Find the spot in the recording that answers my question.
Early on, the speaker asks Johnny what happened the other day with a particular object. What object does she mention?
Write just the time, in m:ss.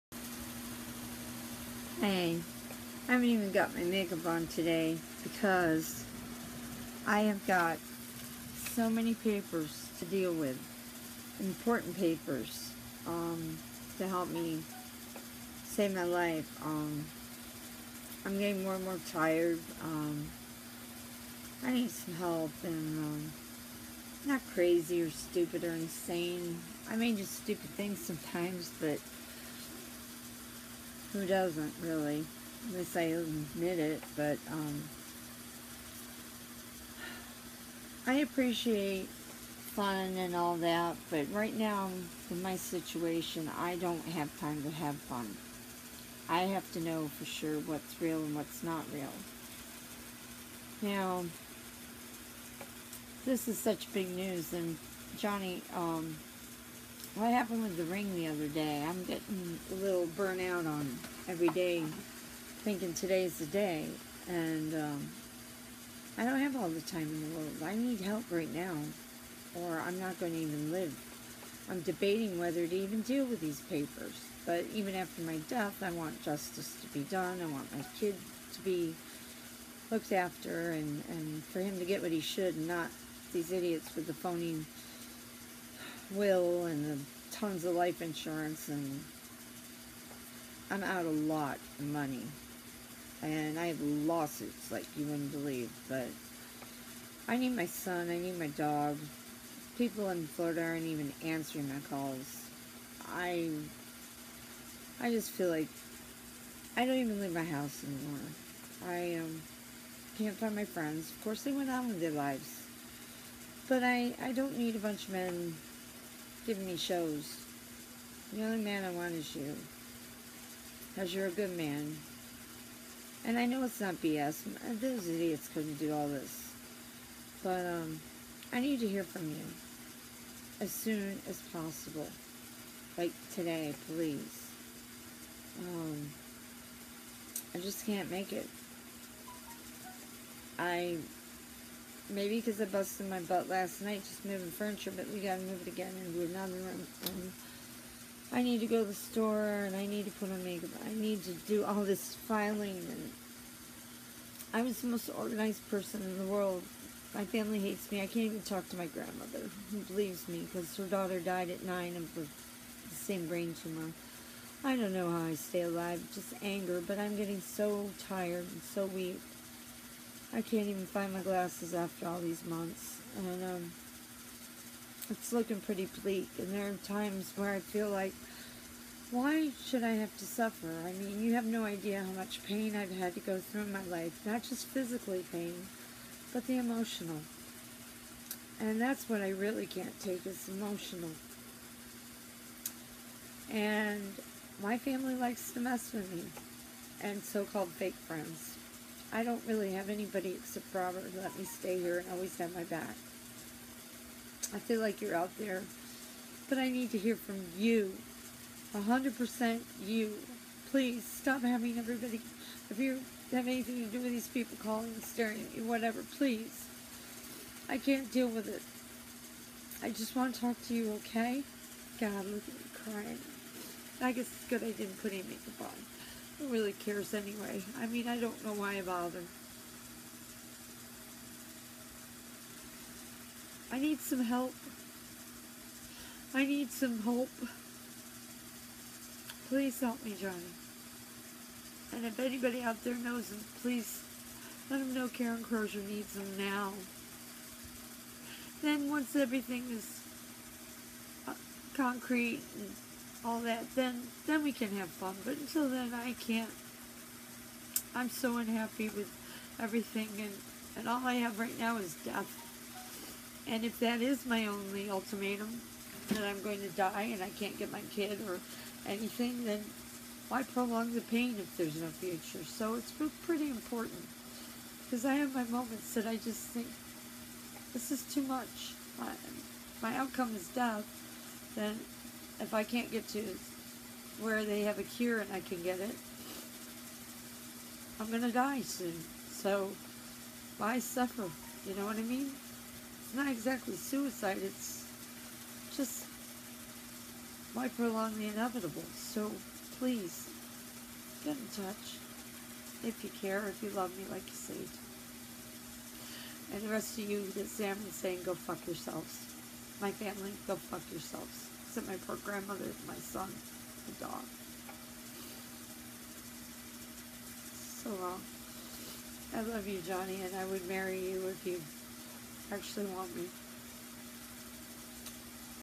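0:57.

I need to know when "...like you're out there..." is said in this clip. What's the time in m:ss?
3:24.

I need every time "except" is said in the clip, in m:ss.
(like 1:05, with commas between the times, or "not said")
3:20, 5:11.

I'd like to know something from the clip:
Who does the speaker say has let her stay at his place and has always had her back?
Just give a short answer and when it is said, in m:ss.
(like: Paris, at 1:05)
Robert, at 3:20.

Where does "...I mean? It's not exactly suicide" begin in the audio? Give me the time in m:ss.
4:51.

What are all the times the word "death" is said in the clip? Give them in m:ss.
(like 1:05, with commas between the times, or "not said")
1:15, 4:22, 4:40.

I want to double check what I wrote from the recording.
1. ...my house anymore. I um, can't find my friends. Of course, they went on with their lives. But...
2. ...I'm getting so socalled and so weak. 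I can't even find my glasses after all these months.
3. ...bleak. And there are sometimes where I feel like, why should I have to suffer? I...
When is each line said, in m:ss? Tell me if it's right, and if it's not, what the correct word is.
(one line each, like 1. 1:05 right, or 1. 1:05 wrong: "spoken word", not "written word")
1. 1:47 right
2. 2:46 wrong: "tired", not "socalled"
3. 2:56 wrong: "times", not "sometimes".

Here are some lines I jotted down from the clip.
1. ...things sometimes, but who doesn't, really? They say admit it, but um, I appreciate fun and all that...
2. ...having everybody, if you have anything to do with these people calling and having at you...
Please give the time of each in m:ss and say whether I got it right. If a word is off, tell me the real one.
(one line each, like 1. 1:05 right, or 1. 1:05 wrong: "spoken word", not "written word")
1. 0:27 right
2. 3:31 wrong: "staring", not "having".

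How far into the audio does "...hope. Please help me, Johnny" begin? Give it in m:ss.
3:57.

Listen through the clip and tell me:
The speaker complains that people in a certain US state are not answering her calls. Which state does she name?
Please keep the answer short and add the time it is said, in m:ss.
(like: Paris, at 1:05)
Florida, at 1:40.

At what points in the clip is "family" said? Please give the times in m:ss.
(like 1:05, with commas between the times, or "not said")
2:37, 3:14, 5:09.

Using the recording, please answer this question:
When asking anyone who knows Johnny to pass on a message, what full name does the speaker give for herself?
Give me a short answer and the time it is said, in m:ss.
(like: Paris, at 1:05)
Karen Crozier, at 4:05.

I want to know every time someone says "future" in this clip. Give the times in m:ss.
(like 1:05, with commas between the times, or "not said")
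4:31.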